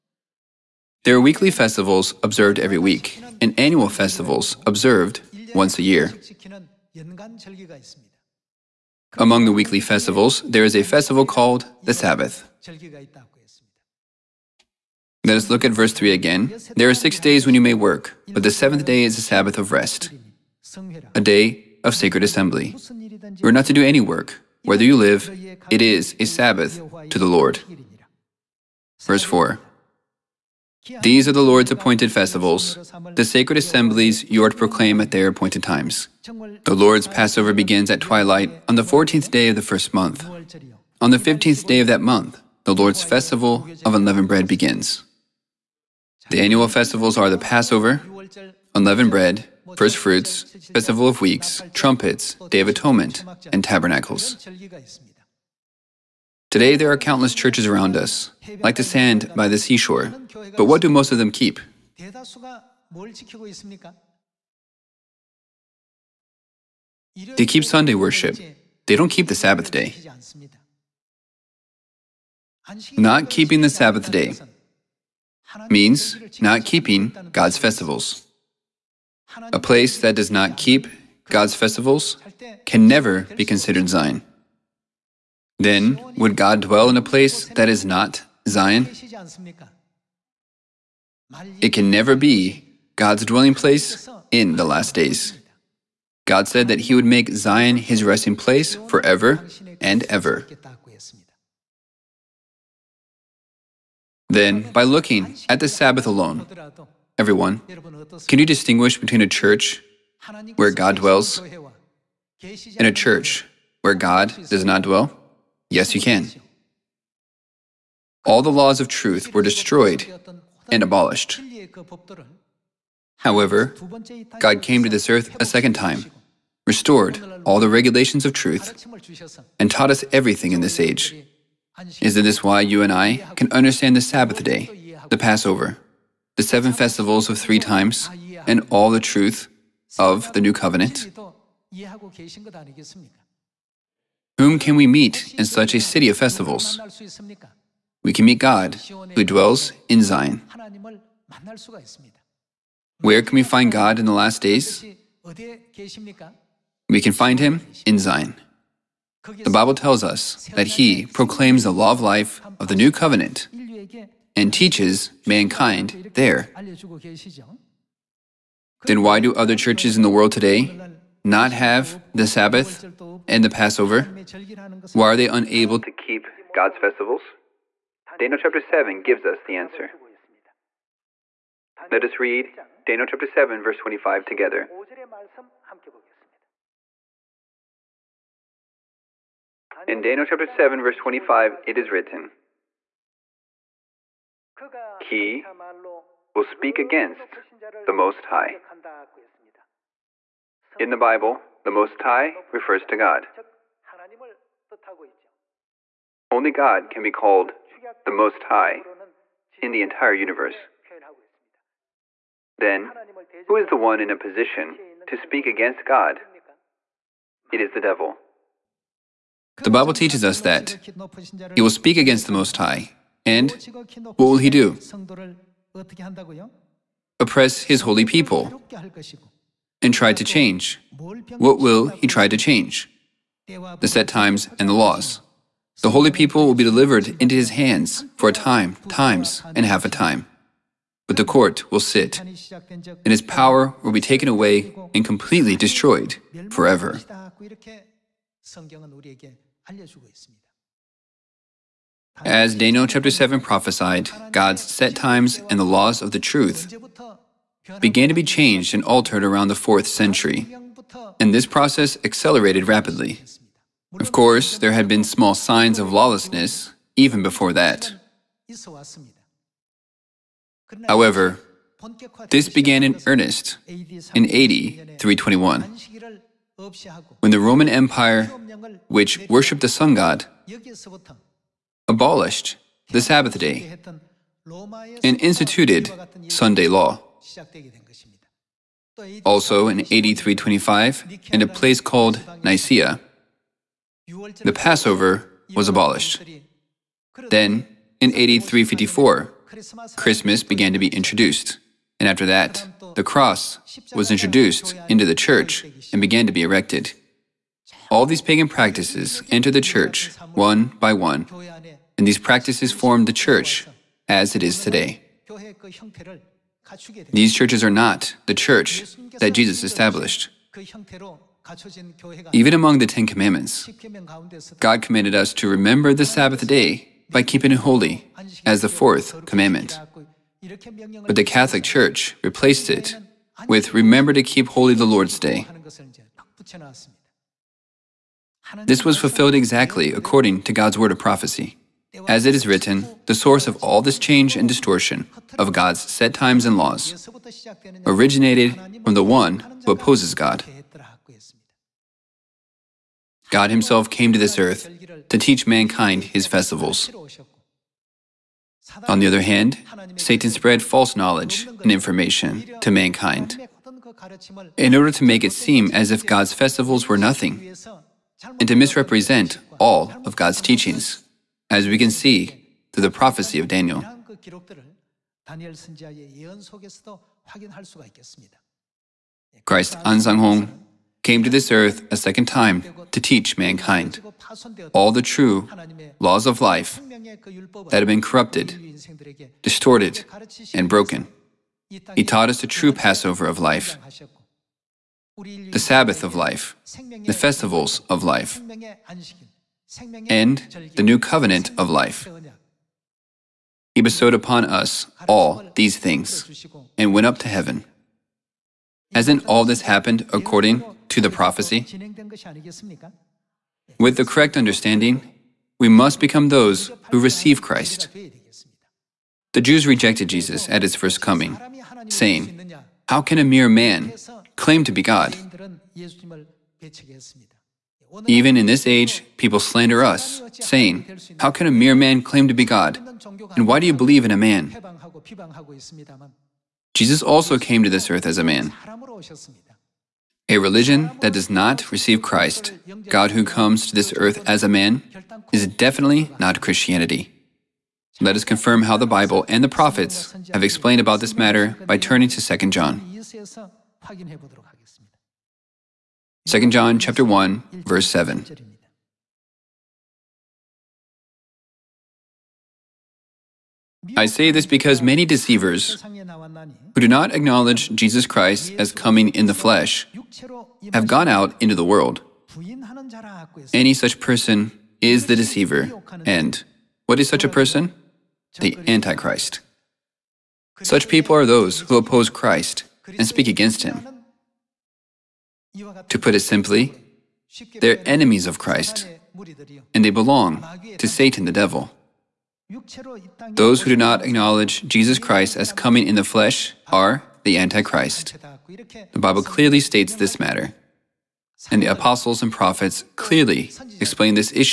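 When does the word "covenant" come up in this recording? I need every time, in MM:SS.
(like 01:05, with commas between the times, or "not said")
02:20, 02:42, 06:40.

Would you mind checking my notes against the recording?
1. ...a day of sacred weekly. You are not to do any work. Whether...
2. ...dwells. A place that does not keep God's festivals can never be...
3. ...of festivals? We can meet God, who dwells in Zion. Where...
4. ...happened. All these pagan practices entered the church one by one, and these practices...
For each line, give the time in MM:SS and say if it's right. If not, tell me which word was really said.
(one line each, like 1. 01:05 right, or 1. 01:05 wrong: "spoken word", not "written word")
1. 00:21 wrong: "assembly", not "weekly"
2. 01:17 wrong: "festivals", not "dwells"
3. 02:26 right
4. 05:06 wrong: "erected", not "happened".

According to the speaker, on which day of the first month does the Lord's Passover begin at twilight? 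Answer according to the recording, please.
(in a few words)
14th day.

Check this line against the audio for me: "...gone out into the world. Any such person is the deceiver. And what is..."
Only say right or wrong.
right.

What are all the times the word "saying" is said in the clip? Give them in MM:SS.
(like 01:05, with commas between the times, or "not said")
07:01, 07:10.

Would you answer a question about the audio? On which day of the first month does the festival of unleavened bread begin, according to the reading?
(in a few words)
15th day.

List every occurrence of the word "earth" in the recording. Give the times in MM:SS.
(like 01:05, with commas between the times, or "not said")
02:05, 05:54, 06:21, 07:17, 07:23.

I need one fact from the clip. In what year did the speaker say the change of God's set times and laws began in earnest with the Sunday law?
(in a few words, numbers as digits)
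AD 321.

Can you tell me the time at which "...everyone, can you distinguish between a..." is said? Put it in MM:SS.
01:47.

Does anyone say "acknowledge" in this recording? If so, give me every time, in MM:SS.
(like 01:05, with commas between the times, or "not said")
07:47, 08:14.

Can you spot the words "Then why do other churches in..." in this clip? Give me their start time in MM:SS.
02:48.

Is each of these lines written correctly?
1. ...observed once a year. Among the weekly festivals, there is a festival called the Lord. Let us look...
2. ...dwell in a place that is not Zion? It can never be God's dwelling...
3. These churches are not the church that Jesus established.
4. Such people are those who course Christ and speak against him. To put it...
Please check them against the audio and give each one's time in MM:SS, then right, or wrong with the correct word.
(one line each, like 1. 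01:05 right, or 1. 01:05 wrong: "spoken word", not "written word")
1. 00:04 wrong: "Sabbath", not "Lord"
2. 01:26 right
3. 05:17 right
4. 08:00 wrong: "oppose", not "course".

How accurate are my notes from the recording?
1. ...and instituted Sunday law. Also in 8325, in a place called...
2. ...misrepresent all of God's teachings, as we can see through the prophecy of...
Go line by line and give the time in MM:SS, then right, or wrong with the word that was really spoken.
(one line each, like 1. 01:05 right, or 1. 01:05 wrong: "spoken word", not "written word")
1. 04:45 right
2. 06:08 right.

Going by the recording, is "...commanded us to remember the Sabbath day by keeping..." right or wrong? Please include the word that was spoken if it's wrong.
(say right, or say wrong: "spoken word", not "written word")
right.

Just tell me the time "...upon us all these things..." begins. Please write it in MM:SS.
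06:44.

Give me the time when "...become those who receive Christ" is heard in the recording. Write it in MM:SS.
06:55.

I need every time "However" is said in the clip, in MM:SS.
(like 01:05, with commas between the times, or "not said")
02:03, 04:30.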